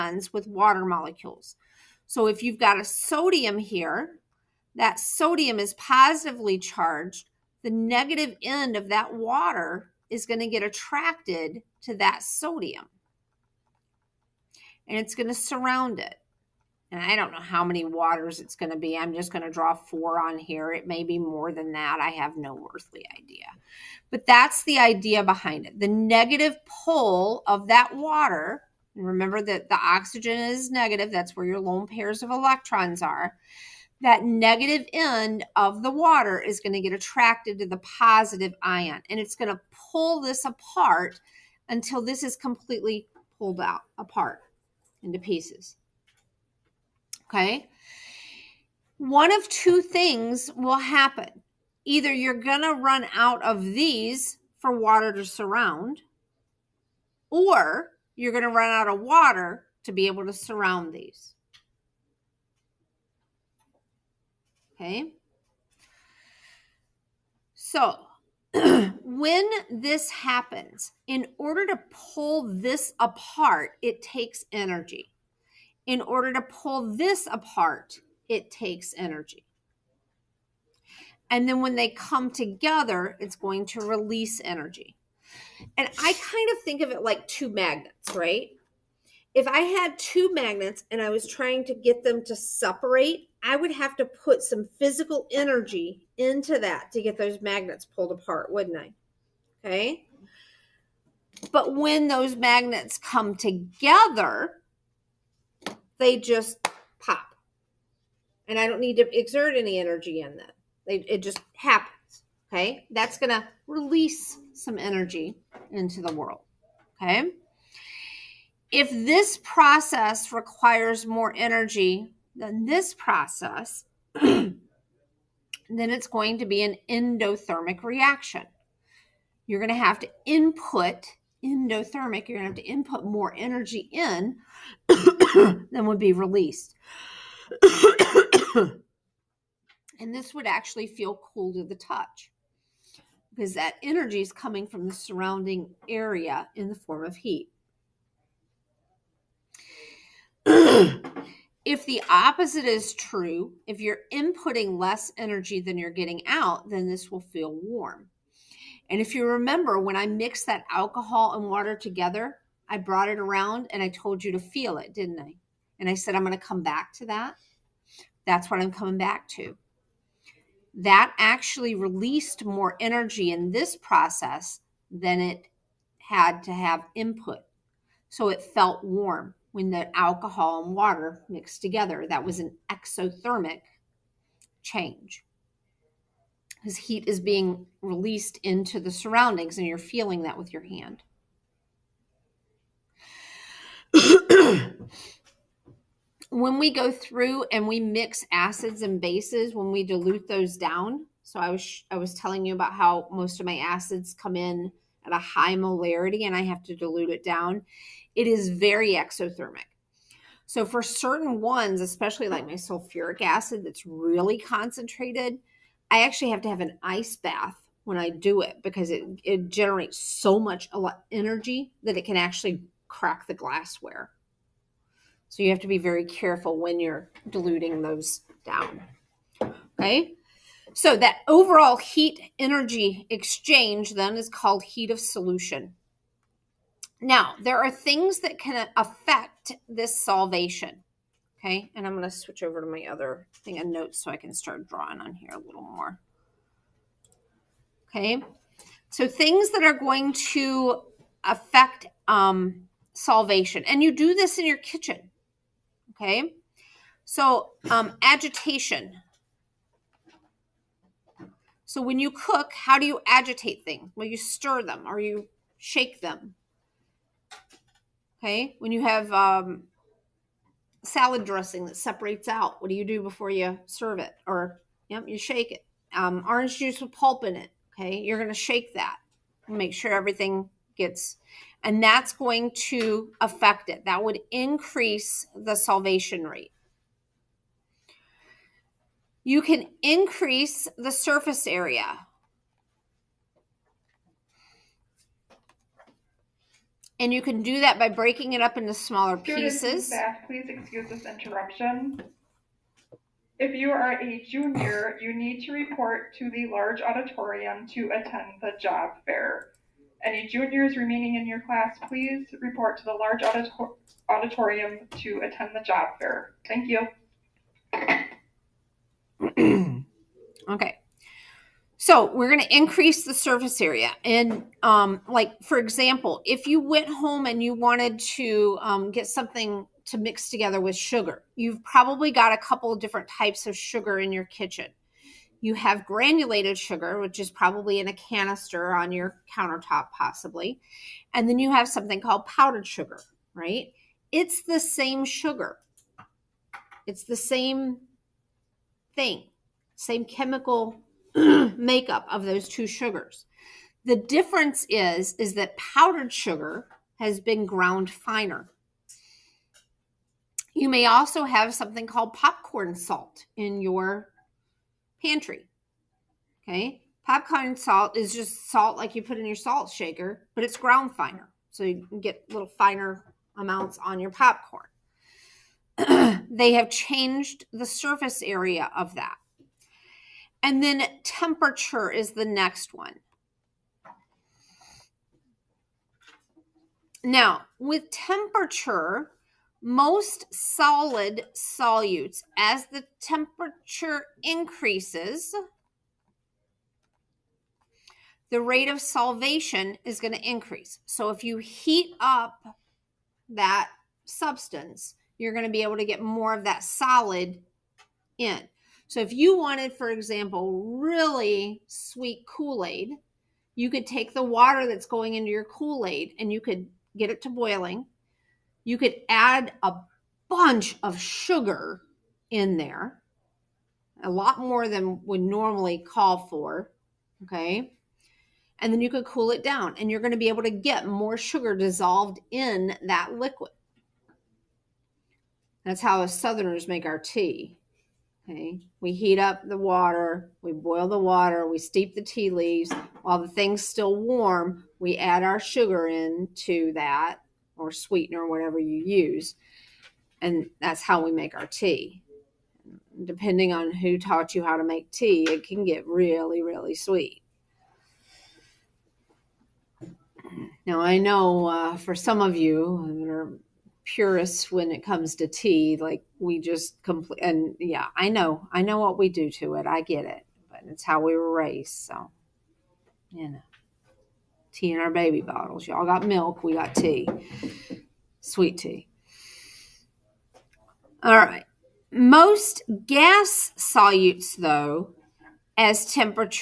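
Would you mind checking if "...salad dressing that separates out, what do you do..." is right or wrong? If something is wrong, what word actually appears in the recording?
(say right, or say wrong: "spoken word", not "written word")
right.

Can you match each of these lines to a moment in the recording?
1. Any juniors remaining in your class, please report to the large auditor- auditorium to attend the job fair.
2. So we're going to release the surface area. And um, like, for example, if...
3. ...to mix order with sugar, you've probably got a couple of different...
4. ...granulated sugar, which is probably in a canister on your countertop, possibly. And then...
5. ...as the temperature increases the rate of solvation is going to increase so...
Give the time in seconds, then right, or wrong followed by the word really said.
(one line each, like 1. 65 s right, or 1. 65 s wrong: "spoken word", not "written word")
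1. 310 s right
2. 321 s wrong: "increase", not "release"
3. 329 s wrong: "together", not "order"
4. 335 s right
5. 392 s right.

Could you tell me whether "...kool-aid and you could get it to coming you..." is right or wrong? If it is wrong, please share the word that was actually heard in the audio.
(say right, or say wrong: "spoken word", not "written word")
wrong: "boiling", not "coming".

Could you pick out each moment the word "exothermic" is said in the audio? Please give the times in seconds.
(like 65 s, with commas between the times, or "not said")
182 s, 208 s.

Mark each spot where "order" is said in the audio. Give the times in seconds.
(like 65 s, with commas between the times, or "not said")
71 s, 76 s.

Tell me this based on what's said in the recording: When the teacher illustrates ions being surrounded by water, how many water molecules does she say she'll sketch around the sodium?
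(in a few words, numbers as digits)
4.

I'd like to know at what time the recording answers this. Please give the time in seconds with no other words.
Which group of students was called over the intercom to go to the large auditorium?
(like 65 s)
304 s.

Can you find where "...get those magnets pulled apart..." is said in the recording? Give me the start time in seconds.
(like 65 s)
97 s.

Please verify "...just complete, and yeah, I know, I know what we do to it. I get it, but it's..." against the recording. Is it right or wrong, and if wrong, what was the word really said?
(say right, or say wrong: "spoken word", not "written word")
right.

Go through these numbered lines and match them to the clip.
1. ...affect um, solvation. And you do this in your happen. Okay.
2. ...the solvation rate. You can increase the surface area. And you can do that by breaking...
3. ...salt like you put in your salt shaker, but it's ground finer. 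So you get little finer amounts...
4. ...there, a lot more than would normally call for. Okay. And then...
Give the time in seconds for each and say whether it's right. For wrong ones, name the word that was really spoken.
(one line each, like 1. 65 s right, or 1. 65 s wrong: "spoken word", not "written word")
1. 251 s wrong: "kitchen", not "happen"
2. 285 s right
3. 368 s right
4. 422 s right.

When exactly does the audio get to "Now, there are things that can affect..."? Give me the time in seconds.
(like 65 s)
236 s.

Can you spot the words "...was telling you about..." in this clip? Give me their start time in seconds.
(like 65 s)
201 s.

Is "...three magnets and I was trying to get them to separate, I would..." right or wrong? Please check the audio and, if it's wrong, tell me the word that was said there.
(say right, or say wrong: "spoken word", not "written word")
wrong: "two", not "three".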